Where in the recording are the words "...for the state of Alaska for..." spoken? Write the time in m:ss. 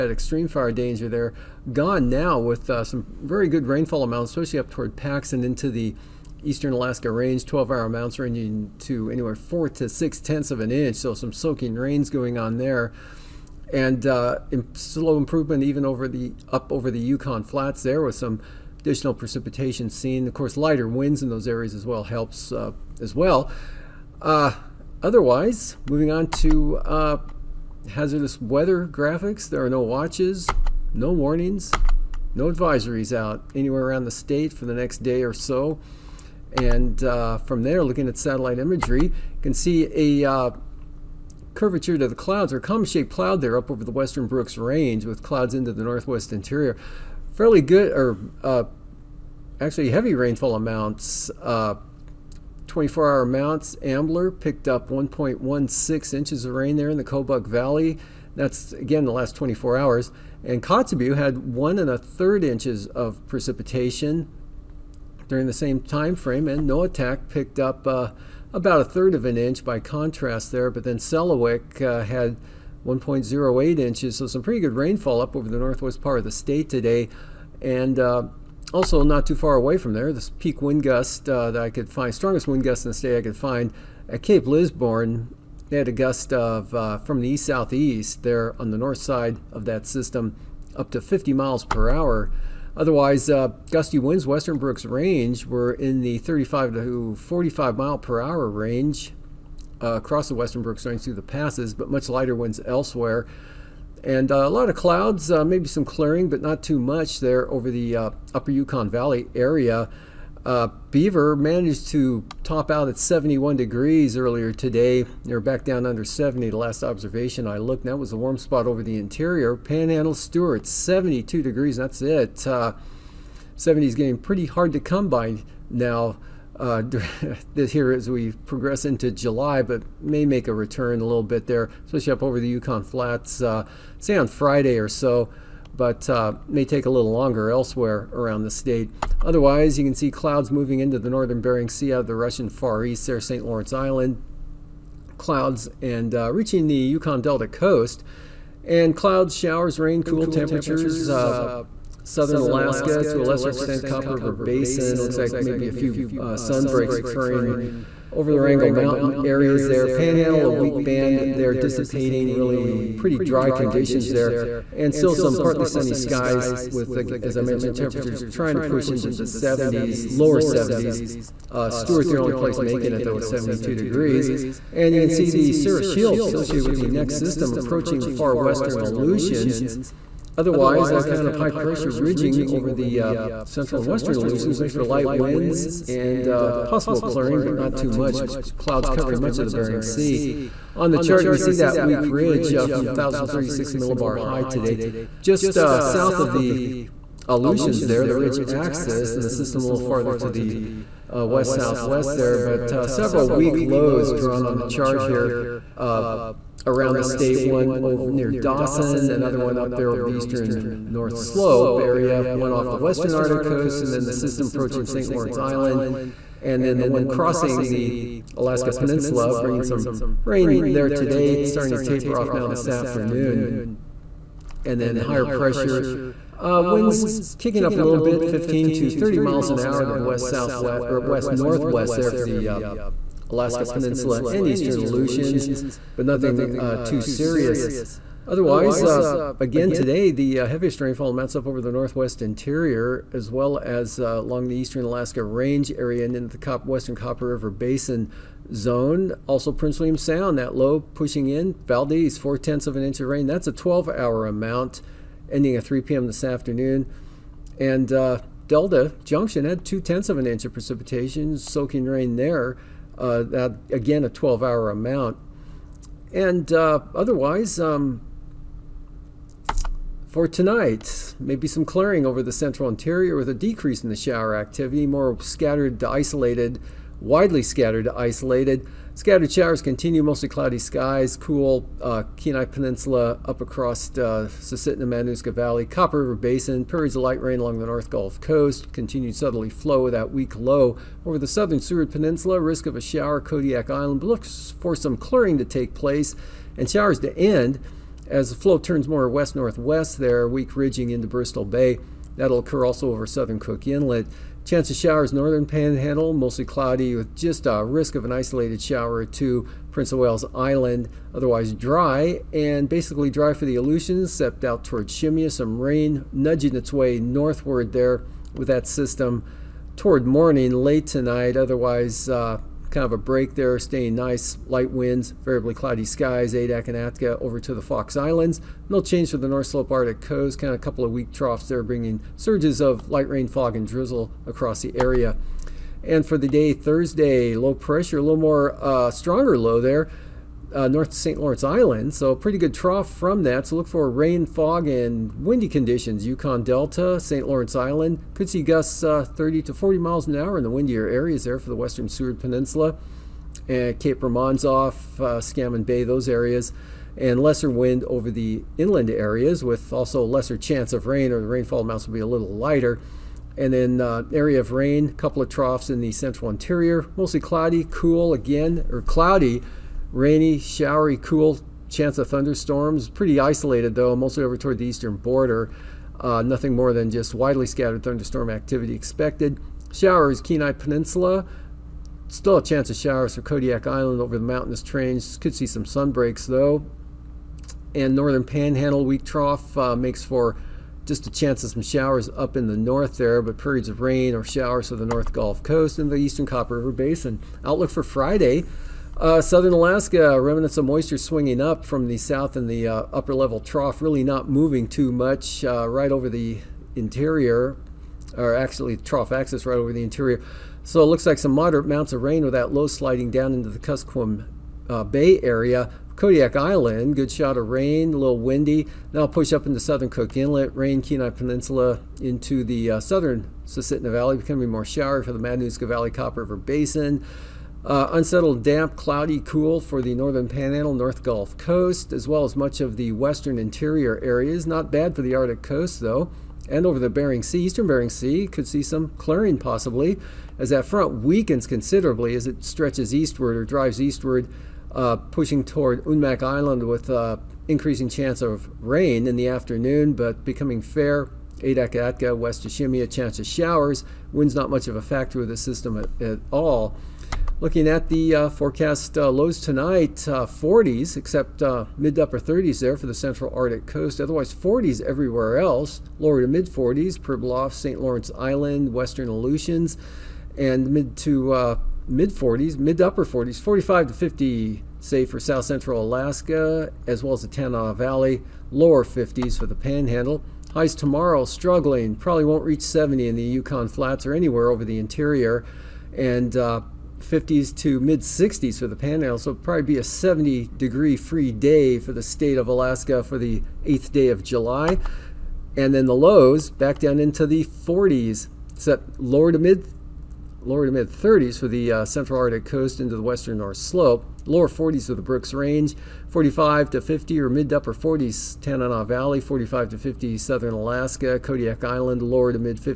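8:11.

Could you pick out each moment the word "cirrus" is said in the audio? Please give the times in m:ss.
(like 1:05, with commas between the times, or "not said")
2:55.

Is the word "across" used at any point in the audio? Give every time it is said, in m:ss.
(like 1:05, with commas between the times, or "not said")
1:39, 4:43, 5:34.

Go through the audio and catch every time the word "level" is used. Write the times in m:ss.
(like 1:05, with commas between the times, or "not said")
6:43.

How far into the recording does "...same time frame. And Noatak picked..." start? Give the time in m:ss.
1:05.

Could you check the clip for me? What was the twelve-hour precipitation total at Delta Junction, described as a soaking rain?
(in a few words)
0.2 inches.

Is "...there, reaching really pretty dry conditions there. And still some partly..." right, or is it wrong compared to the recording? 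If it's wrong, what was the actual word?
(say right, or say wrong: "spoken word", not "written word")
wrong: "dissipating", not "reaching".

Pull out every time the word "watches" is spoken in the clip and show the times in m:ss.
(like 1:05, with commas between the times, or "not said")
0:29.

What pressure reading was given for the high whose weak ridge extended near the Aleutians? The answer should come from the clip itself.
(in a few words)
1,036 millibars.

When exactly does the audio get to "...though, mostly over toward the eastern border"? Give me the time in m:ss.
6:13.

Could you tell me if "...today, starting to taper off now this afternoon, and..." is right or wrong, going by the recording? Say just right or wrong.
right.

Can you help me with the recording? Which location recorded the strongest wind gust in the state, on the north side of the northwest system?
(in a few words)
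Cape Lisburne.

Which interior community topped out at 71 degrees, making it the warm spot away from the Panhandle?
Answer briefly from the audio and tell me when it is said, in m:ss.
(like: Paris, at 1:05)
Beaver, at 1:50.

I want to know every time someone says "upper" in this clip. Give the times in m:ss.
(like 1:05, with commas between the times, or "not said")
1:48, 6:42, 7:42, 7:52, 8:27.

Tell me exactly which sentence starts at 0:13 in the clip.
And uh, slow improvement even over the up over the Yukon flats there with some additional precipitation seen.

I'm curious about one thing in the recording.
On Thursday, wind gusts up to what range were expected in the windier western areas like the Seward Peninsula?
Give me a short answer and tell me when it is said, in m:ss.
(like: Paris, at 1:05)
30 to 40 mph, at 5:49.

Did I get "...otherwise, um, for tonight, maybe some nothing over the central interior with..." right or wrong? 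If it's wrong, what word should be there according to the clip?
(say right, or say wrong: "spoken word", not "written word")
wrong: "clearing", not "nothing".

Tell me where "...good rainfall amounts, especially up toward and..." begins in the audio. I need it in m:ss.
0:03.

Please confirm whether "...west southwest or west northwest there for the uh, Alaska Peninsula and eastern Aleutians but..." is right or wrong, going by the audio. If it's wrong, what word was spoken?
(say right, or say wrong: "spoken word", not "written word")
right.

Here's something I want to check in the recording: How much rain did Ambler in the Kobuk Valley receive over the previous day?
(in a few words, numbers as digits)
1.16 inches.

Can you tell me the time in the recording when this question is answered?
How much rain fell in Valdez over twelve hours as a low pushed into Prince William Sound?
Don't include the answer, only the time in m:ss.
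4:12.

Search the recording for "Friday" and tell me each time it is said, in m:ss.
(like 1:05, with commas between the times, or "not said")
2:14, 6:37.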